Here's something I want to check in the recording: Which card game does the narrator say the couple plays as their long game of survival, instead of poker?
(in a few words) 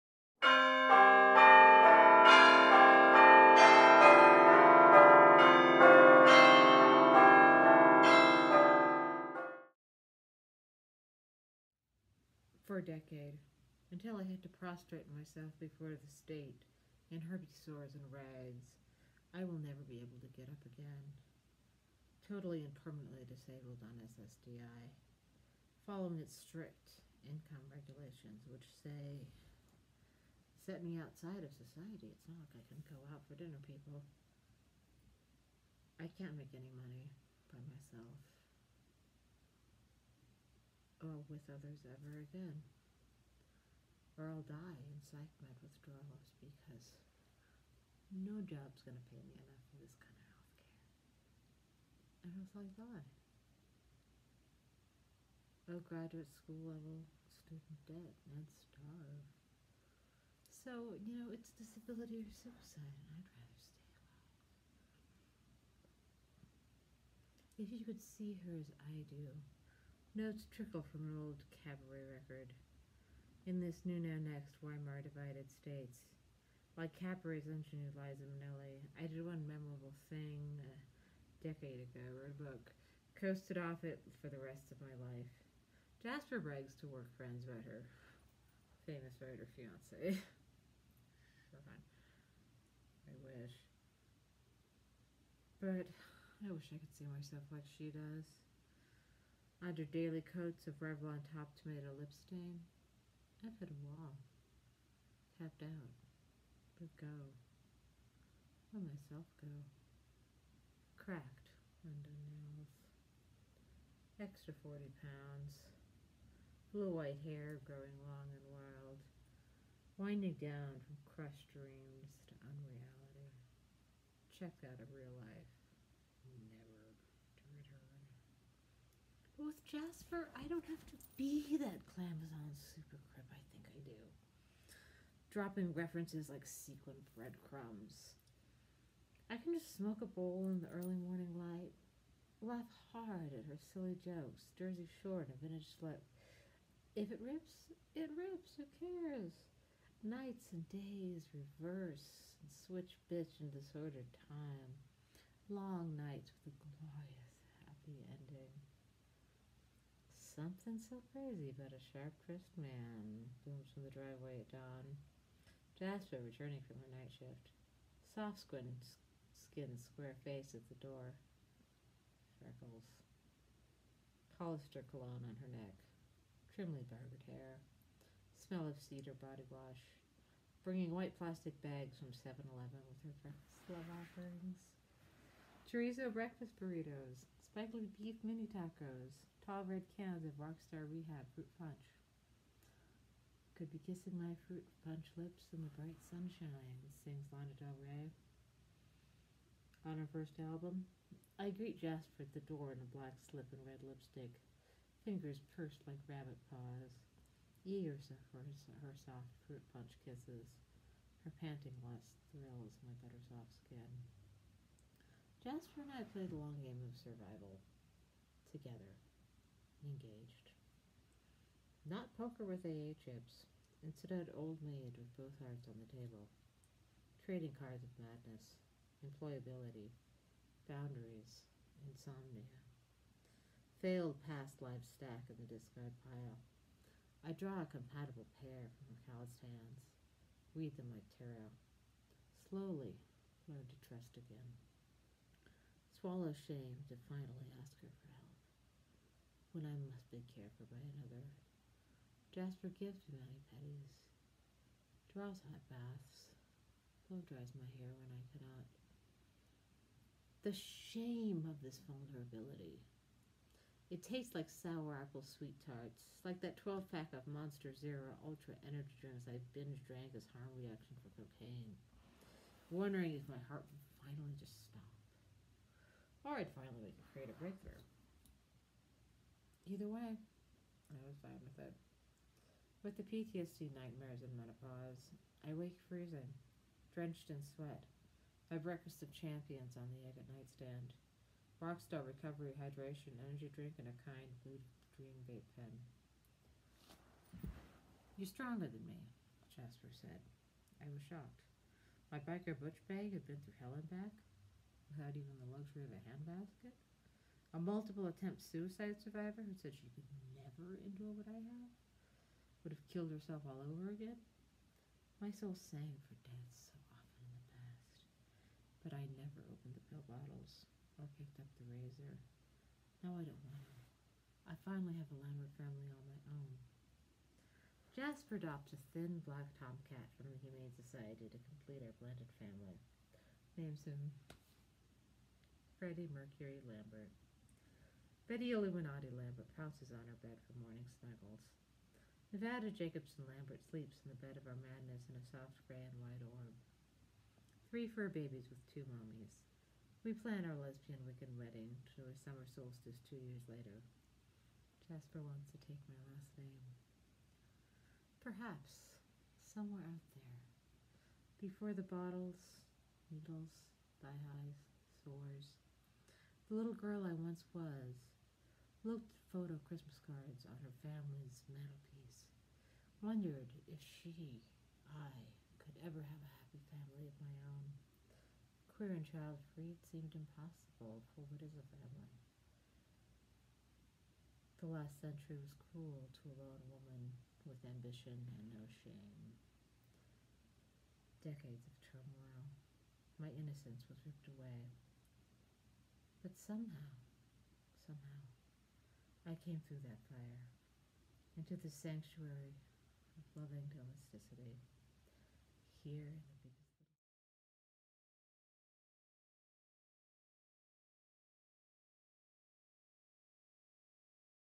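Old maid.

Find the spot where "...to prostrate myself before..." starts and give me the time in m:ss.
0:14.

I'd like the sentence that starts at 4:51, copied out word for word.
Rockstar recovery hydration energy drink and a kind blue dream vape pen.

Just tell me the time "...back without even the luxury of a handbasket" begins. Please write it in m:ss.
5:03.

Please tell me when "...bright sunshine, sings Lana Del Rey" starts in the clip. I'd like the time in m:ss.
3:15.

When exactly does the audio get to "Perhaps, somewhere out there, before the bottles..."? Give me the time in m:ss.
5:58.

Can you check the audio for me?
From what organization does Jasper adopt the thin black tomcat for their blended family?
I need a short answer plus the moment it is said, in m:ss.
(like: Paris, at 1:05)
Humane Society, at 5:30.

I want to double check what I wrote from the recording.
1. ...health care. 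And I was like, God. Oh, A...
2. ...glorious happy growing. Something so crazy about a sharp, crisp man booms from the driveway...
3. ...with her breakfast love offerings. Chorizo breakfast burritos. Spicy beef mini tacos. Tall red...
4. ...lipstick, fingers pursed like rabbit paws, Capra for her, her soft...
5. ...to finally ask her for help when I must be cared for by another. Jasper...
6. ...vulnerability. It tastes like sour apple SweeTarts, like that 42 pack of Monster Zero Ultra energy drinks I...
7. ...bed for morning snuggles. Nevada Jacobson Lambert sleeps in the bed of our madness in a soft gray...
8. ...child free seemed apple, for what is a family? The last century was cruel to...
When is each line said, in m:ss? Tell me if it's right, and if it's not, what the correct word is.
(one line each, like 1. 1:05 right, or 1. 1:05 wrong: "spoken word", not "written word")
1. 0:50 right
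2. 2:36 wrong: "ending", not "growing"
3. 3:02 right
4. 3:23 wrong: "Years", not "Capra"
5. 4:06 right
6. 4:21 wrong: "12", not "42"
7. 5:40 right
8. 6:19 wrong: "impossible", not "apple".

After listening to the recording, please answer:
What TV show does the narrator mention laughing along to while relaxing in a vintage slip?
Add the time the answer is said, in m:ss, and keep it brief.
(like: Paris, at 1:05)
Jersey Shore, at 2:24.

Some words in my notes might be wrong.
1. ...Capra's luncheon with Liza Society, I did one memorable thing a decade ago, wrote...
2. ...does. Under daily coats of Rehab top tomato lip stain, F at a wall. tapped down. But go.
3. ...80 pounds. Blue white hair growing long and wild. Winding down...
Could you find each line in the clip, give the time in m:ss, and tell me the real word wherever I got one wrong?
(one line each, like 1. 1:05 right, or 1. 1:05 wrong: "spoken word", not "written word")
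1. 1:16 wrong: "Minnelli", not "Society"
2. 1:37 wrong: "Revlon", not "Rehab"
3. 1:54 wrong: "40", not "80".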